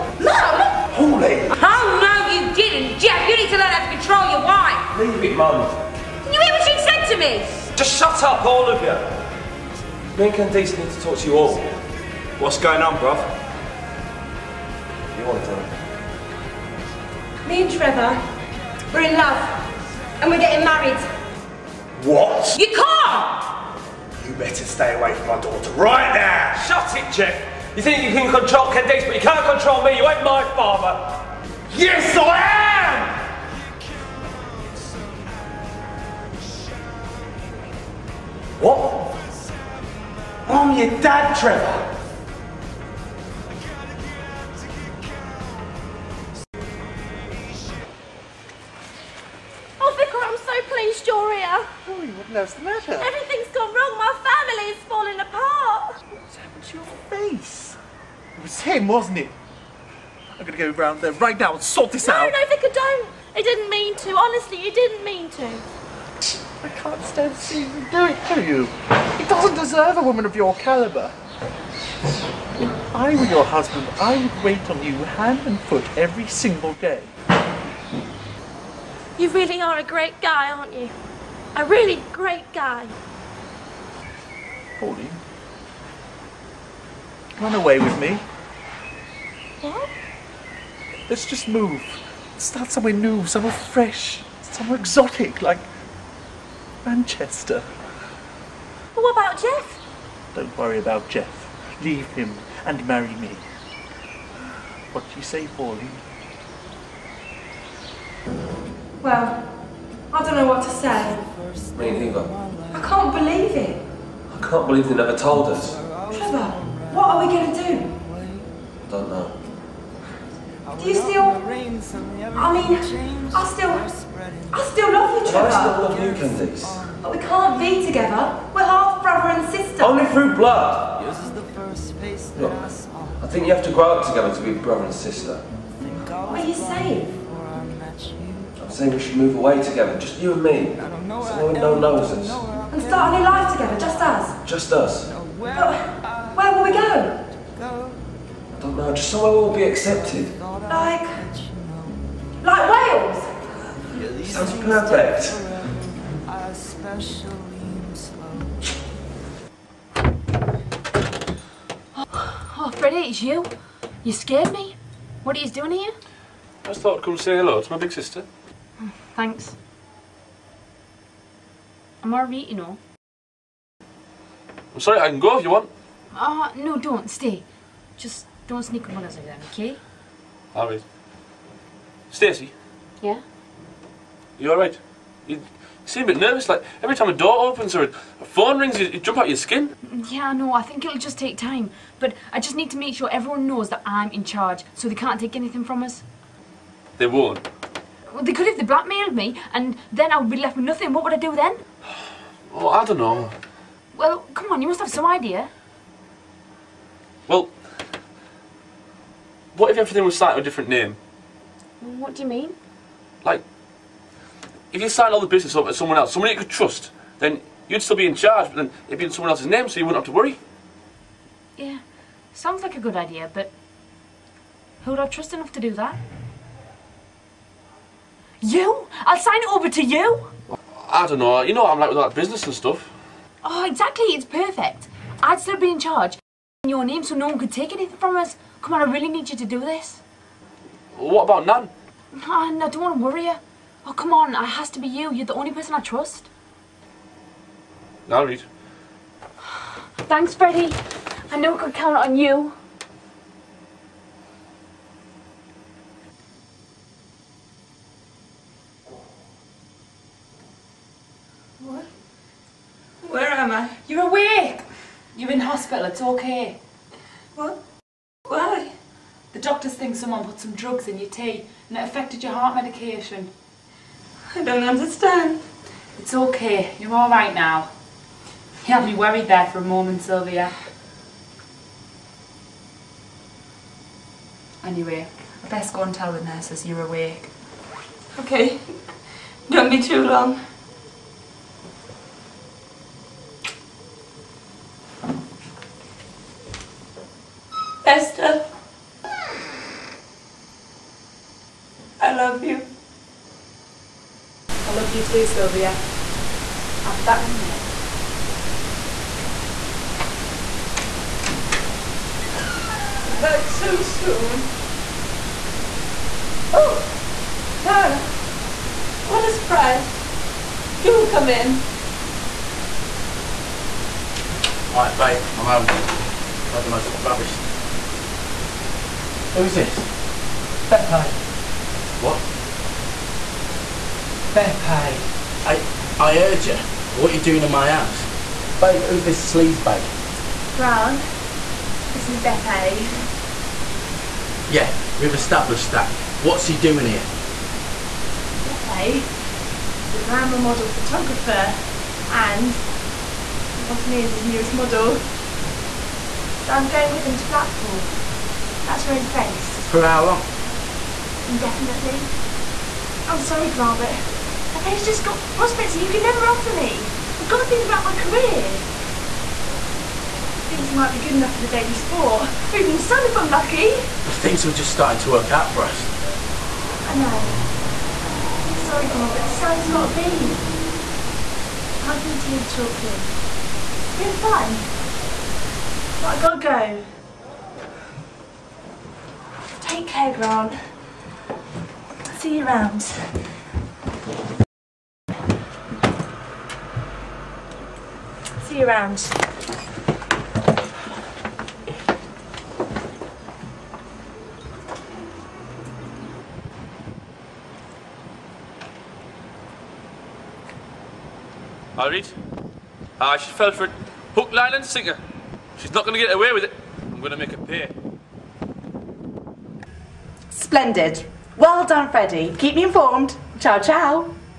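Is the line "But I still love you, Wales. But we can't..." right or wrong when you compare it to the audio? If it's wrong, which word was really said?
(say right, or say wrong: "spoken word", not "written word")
wrong: "Candice", not "Wales".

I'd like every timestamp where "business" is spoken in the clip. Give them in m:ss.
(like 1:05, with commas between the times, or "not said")
3:35, 3:52.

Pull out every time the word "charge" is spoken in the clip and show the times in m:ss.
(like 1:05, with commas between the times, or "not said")
3:14, 3:38, 3:55.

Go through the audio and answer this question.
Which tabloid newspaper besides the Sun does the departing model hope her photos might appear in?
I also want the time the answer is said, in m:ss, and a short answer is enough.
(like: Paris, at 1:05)
Daily Sport, at 6:11.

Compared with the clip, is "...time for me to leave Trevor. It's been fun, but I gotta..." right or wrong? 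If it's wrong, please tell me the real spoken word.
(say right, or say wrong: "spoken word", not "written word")
wrong: "Chalklin", not "Trevor".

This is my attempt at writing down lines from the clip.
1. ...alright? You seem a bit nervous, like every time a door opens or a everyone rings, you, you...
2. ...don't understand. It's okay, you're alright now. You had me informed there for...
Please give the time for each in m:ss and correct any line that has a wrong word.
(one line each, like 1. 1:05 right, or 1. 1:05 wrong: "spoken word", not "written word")
1. 3:04 wrong: "phone", not "everyone"
2. 4:34 wrong: "worried", not "informed".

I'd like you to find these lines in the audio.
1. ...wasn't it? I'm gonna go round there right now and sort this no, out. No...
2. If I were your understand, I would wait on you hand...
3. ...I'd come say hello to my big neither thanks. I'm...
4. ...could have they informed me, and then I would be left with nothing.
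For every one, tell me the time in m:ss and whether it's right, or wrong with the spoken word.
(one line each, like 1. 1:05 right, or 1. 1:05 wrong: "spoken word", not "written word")
1. 0:58 right
2. 1:11 wrong: "husband", not "understand"
3. 2:46 wrong: "sister", not "neither"
4. 3:18 wrong: "blackmailed", not "informed".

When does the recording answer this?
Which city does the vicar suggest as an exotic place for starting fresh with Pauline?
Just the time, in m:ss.
1:36.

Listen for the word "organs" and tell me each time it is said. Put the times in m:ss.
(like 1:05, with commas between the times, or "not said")
not said.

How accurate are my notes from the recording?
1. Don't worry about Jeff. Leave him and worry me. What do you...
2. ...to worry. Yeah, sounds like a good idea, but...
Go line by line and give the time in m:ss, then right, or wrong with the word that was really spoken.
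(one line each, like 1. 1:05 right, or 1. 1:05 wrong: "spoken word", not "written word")
1. 1:40 wrong: "marry", not "worry"
2. 3:40 right.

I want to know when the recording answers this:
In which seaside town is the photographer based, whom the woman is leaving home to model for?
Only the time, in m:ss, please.
5:57.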